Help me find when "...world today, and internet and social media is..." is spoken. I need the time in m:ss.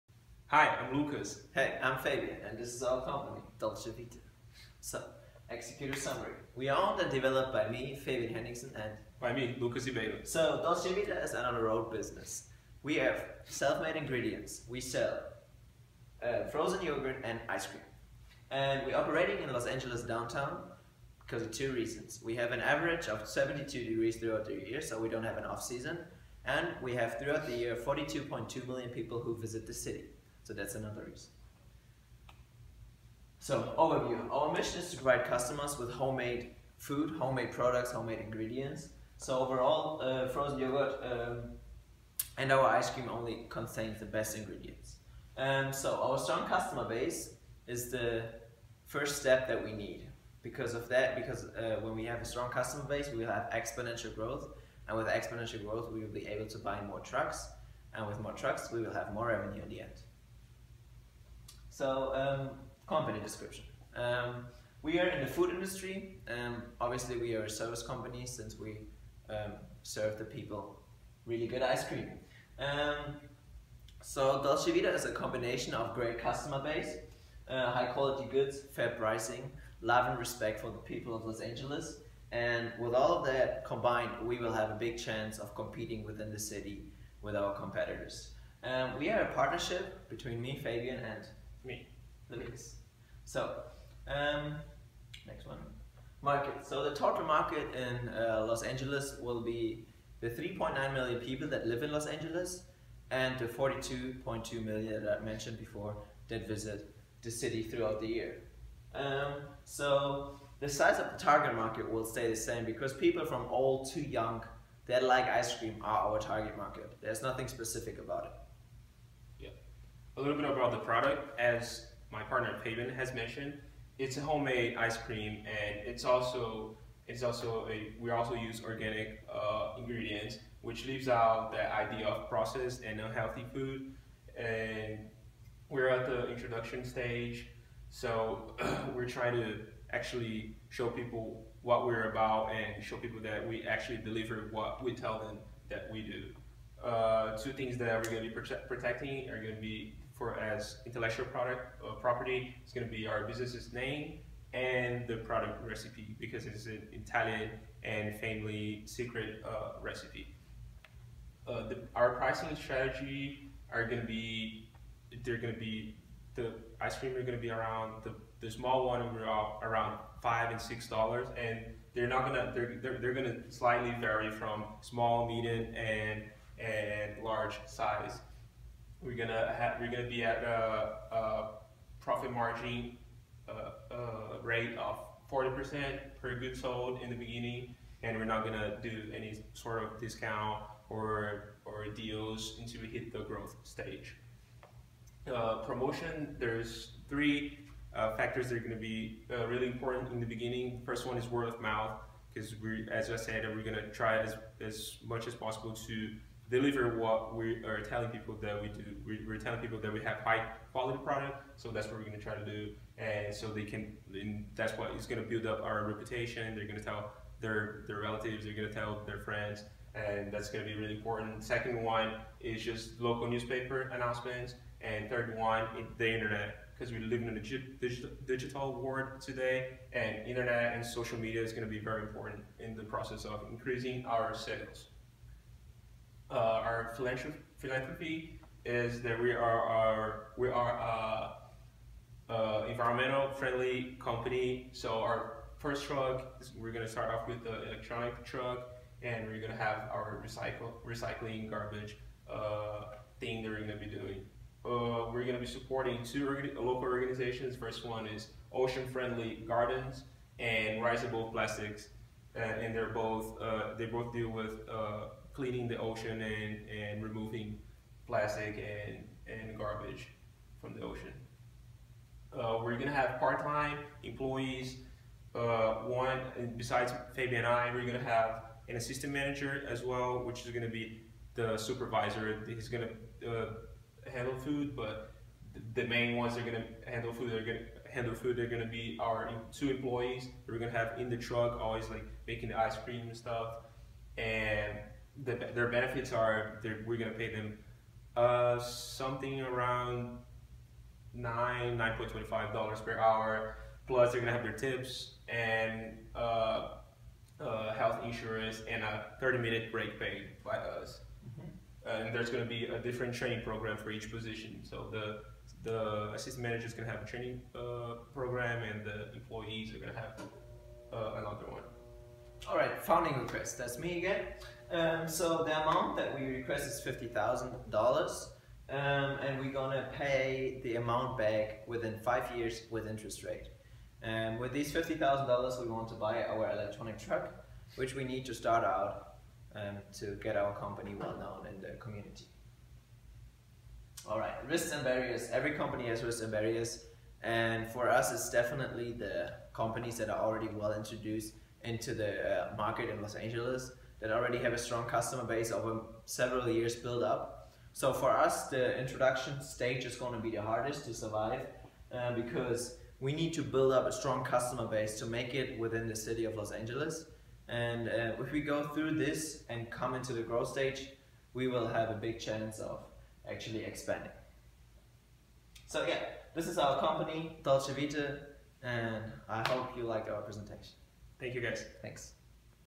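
3:48.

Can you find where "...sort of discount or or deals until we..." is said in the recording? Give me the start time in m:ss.
3:09.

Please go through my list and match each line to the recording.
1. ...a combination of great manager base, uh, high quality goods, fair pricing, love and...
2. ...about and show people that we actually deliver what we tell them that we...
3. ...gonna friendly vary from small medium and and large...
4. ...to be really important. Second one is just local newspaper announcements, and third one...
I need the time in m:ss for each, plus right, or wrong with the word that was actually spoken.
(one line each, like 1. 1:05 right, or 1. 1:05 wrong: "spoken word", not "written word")
1. 1:15 wrong: "customer", not "manager"
2. 2:22 right
3. 2:53 wrong: "slightly", not "friendly"
4. 3:40 right.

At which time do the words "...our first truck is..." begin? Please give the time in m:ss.
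4:04.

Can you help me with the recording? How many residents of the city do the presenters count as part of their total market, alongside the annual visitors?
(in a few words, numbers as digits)
3.9 million.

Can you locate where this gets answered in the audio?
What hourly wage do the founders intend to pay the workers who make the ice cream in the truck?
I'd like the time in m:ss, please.
5:01.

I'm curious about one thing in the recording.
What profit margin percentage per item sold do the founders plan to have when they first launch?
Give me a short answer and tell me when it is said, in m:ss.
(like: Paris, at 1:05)
40%, at 3:05.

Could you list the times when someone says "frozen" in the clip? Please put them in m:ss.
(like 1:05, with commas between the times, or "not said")
0:16, 0:40.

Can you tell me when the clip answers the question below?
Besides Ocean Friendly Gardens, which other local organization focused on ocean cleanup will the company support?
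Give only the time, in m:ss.
4:20.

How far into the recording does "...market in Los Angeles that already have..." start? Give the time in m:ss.
5:52.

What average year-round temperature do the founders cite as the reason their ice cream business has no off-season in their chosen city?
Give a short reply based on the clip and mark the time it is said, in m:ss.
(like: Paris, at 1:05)
72 degrees, at 0:23.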